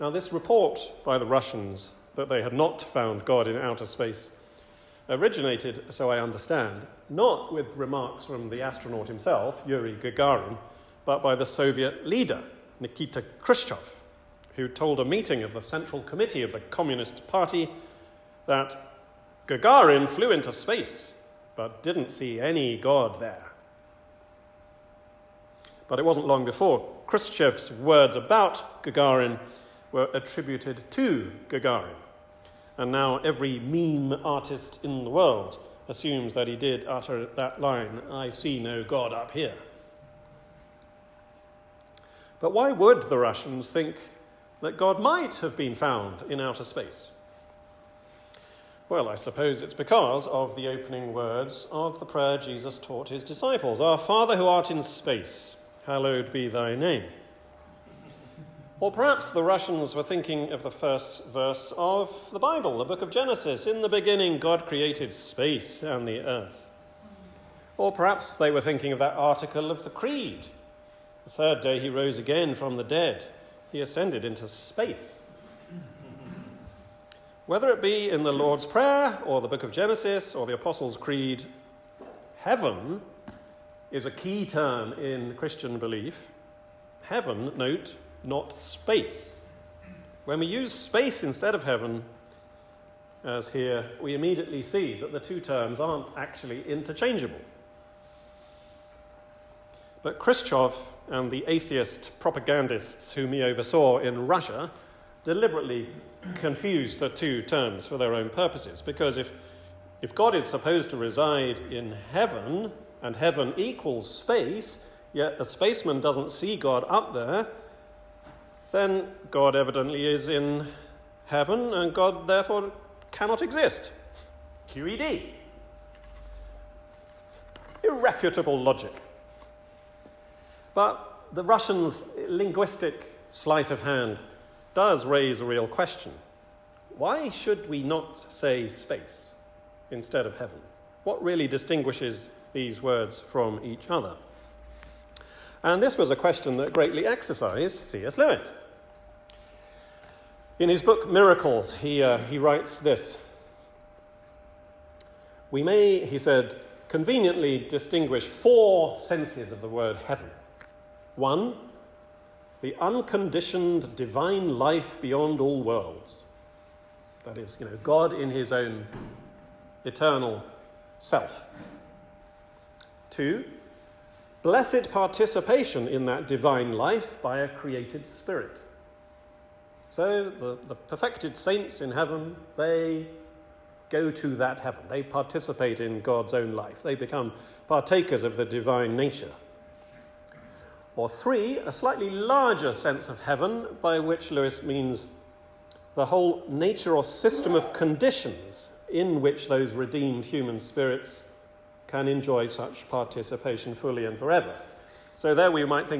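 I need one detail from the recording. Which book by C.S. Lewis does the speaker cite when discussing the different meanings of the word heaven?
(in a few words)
Miracles.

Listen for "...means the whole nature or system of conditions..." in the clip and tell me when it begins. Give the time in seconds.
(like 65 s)
194 s.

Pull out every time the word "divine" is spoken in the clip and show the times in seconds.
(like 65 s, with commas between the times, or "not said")
163 s, 176 s, 188 s.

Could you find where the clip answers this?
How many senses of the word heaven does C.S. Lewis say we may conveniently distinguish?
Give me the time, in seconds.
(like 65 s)
158 s.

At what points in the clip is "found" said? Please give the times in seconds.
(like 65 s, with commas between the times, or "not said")
2 s, 45 s.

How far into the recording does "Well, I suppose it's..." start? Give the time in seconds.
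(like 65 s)
48 s.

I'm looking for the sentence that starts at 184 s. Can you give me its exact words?
They participate in God's own life.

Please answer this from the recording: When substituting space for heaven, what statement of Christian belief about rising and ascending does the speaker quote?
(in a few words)
The Creed.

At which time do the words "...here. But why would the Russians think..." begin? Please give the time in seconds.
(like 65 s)
39 s.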